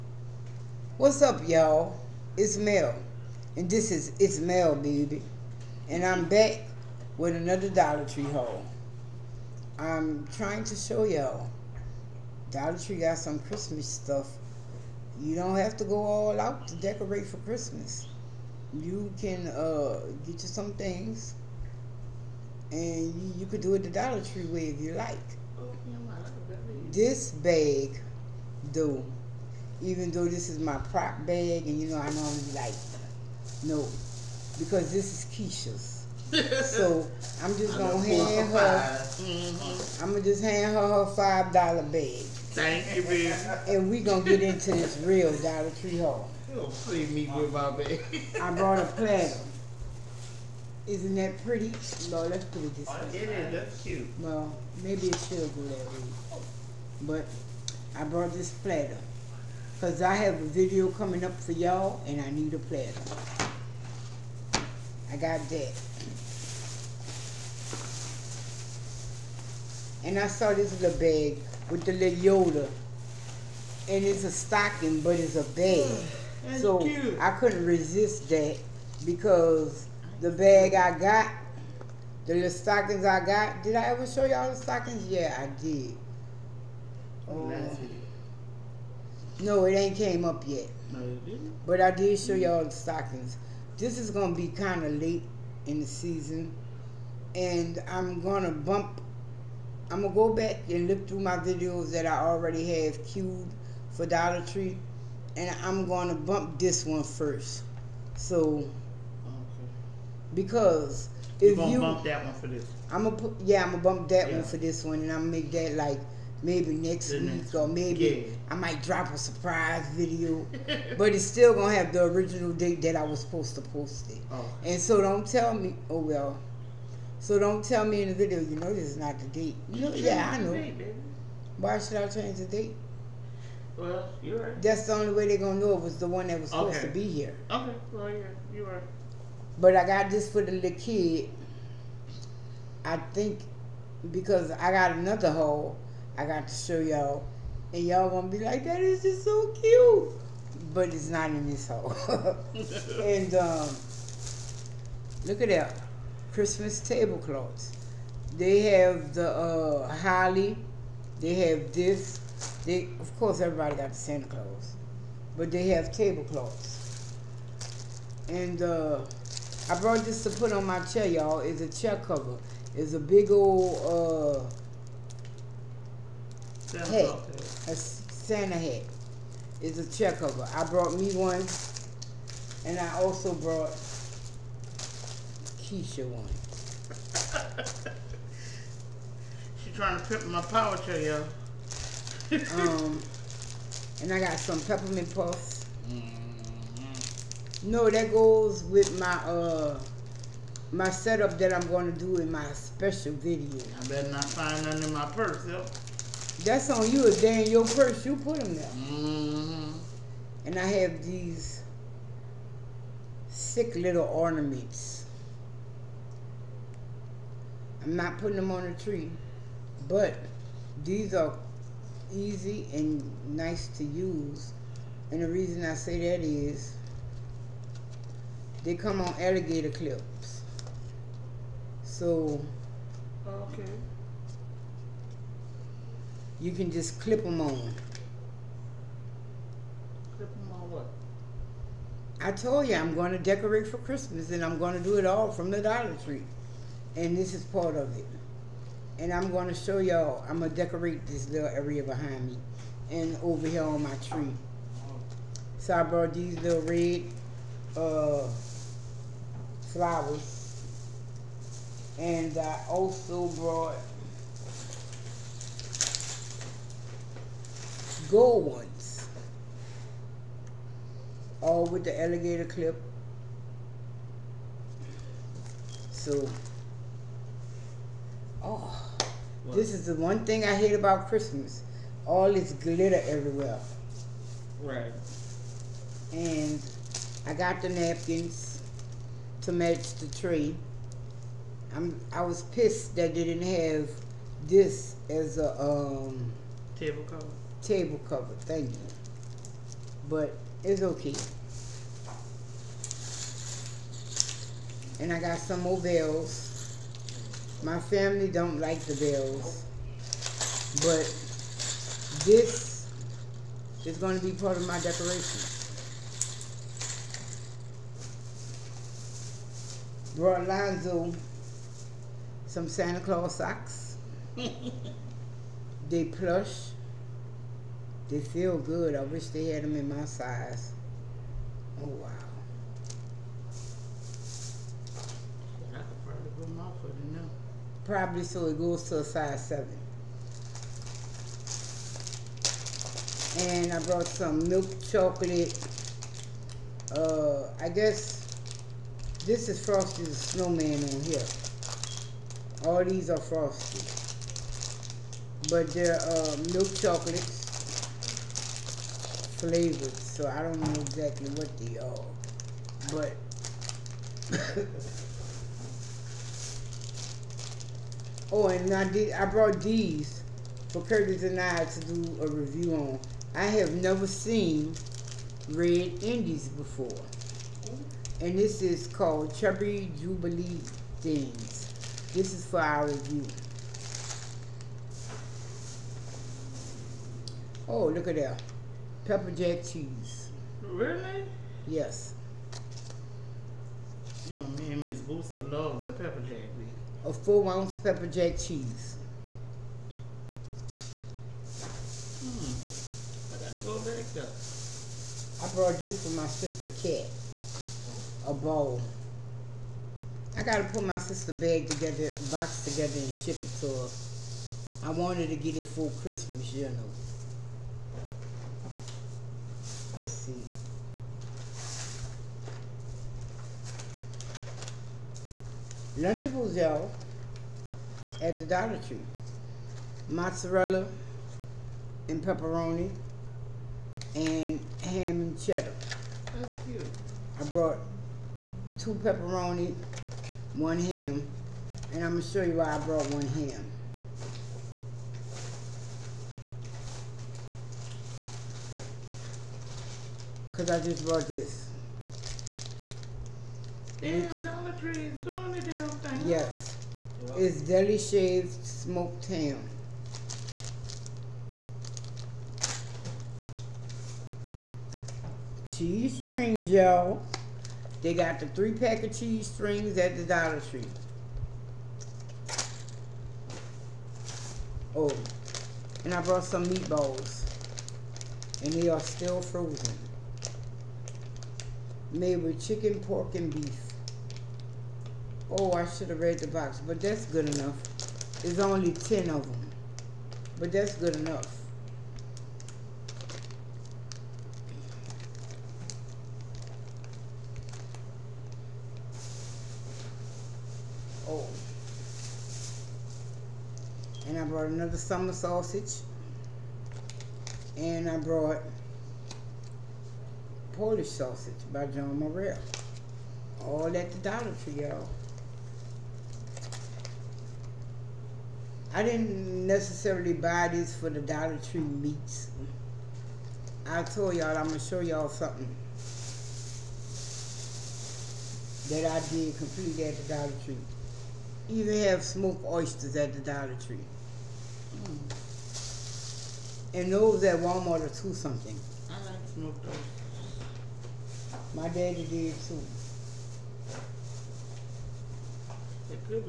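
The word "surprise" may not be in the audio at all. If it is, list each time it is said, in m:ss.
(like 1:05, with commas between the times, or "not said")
1:59.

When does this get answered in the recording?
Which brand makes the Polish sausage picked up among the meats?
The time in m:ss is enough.
8:31.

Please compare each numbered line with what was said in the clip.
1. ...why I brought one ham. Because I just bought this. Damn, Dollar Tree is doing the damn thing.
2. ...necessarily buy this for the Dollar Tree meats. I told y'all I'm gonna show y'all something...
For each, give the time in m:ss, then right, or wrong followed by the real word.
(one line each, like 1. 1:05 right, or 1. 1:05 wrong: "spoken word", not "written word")
1. 7:22 right
2. 8:39 right.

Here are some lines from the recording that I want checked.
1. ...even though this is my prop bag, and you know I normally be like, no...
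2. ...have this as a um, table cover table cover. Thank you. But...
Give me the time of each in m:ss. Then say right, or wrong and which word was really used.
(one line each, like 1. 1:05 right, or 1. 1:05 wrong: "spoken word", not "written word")
1. 0:29 right
2. 4:53 right.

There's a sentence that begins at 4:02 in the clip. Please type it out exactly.
I told you I'm going to decorate for Christmas and I'm going to do it all from the Dollar Tree.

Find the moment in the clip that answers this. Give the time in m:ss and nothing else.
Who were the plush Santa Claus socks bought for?
5:20.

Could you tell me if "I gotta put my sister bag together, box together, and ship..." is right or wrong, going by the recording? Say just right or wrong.
right.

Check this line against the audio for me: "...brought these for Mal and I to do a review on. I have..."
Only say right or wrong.
wrong.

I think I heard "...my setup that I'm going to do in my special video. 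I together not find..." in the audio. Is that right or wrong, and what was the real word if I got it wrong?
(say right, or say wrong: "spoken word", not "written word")
wrong: "better", not "together".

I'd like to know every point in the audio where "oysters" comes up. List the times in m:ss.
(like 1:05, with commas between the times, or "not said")
8:52, 8:59.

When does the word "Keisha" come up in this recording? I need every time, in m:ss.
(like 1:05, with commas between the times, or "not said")
0:35, 3:05.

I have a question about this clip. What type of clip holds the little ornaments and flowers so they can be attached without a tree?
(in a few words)
Alligator clips.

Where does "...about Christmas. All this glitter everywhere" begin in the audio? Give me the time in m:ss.
4:40.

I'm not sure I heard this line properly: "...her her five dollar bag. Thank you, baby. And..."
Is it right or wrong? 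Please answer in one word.
right.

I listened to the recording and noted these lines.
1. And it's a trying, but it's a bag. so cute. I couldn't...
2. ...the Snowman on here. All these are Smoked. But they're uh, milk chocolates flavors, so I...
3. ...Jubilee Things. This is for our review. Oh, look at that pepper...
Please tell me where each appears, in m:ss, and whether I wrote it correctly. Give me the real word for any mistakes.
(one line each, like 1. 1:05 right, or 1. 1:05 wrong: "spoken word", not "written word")
1. 1:13 wrong: "stocking", not "trying"
2. 5:50 wrong: "Frosty", not "Smoked"
3. 6:19 right.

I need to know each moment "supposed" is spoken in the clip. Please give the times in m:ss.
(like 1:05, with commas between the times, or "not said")
2:03, 2:16.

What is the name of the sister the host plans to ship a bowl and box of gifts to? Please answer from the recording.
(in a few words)
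Cat.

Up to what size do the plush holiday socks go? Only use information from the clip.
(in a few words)
Size 7.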